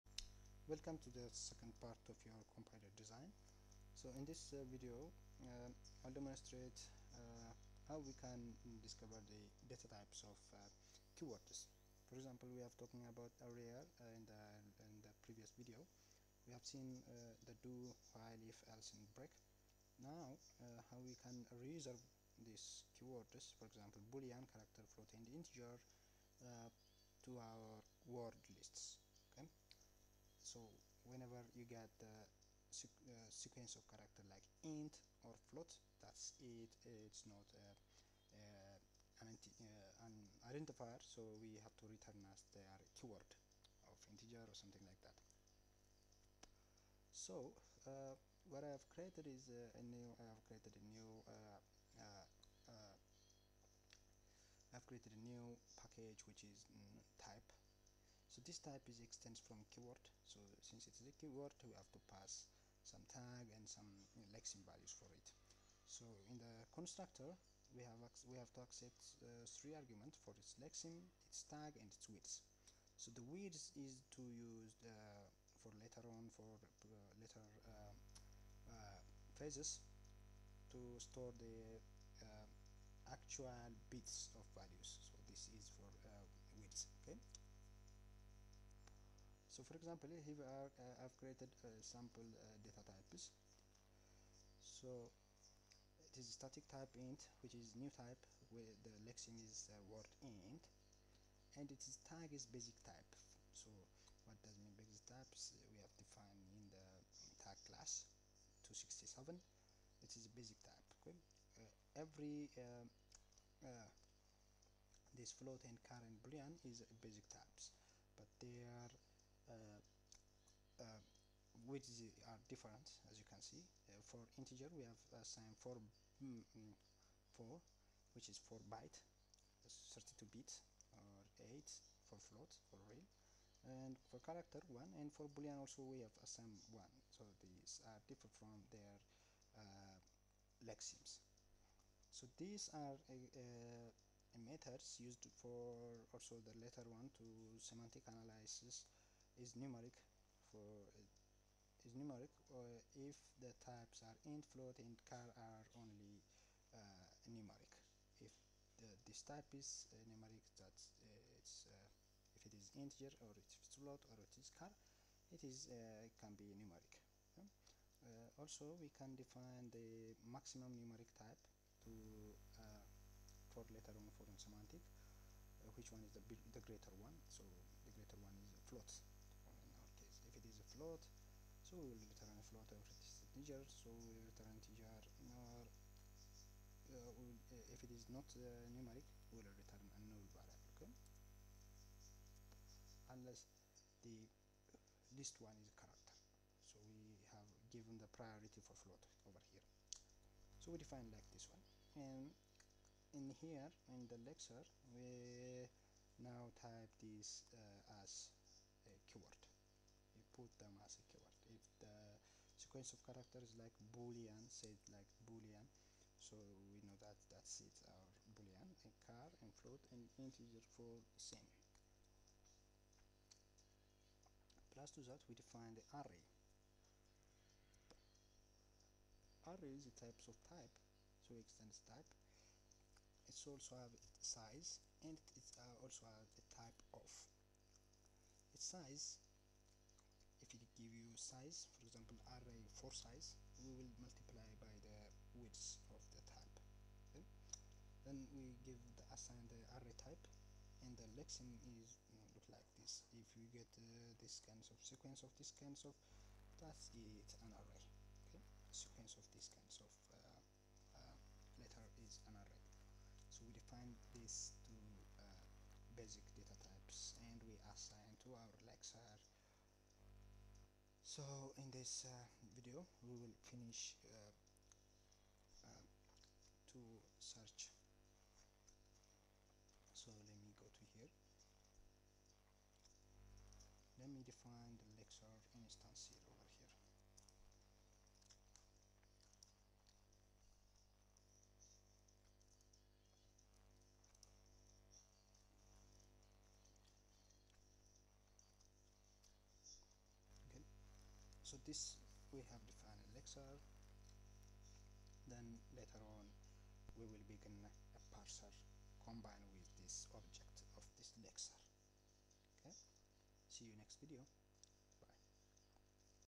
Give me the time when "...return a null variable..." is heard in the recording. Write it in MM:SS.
03:09.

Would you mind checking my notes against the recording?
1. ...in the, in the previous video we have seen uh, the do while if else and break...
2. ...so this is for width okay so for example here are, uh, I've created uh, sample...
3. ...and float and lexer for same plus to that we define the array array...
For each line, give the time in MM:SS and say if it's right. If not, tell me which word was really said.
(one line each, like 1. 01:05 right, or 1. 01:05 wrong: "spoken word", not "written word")
1. 00:14 right
2. 01:25 right
3. 03:39 wrong: "integer", not "lexer".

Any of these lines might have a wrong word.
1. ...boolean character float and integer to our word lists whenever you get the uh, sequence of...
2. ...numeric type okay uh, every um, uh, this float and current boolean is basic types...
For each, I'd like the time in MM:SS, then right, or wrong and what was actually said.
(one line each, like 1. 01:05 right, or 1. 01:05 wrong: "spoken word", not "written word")
1. 00:24 right
2. 01:50 wrong: "basic", not "numeric".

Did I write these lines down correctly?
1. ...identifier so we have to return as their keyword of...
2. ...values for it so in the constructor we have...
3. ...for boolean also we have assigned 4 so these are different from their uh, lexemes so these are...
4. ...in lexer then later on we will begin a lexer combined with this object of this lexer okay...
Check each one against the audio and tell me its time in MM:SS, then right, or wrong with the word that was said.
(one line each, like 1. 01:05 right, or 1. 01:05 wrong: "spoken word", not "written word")
1. 00:40 right
2. 01:04 right
3. 02:15 wrong: "1", not "4"
4. 05:03 wrong: "parser", not "lexer".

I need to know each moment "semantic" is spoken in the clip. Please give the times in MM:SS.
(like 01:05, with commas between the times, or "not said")
02:27, 02:54.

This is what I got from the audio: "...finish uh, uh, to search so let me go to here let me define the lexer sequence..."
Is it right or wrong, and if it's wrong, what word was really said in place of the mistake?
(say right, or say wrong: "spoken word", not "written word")
wrong: "instance", not "sequence".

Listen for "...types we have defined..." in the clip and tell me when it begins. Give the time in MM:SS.
01:45.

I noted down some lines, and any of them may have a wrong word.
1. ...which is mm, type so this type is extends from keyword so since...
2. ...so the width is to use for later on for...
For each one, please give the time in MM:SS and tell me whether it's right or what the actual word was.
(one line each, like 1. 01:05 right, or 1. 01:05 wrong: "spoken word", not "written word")
1. 00:56 right
2. 01:12 right.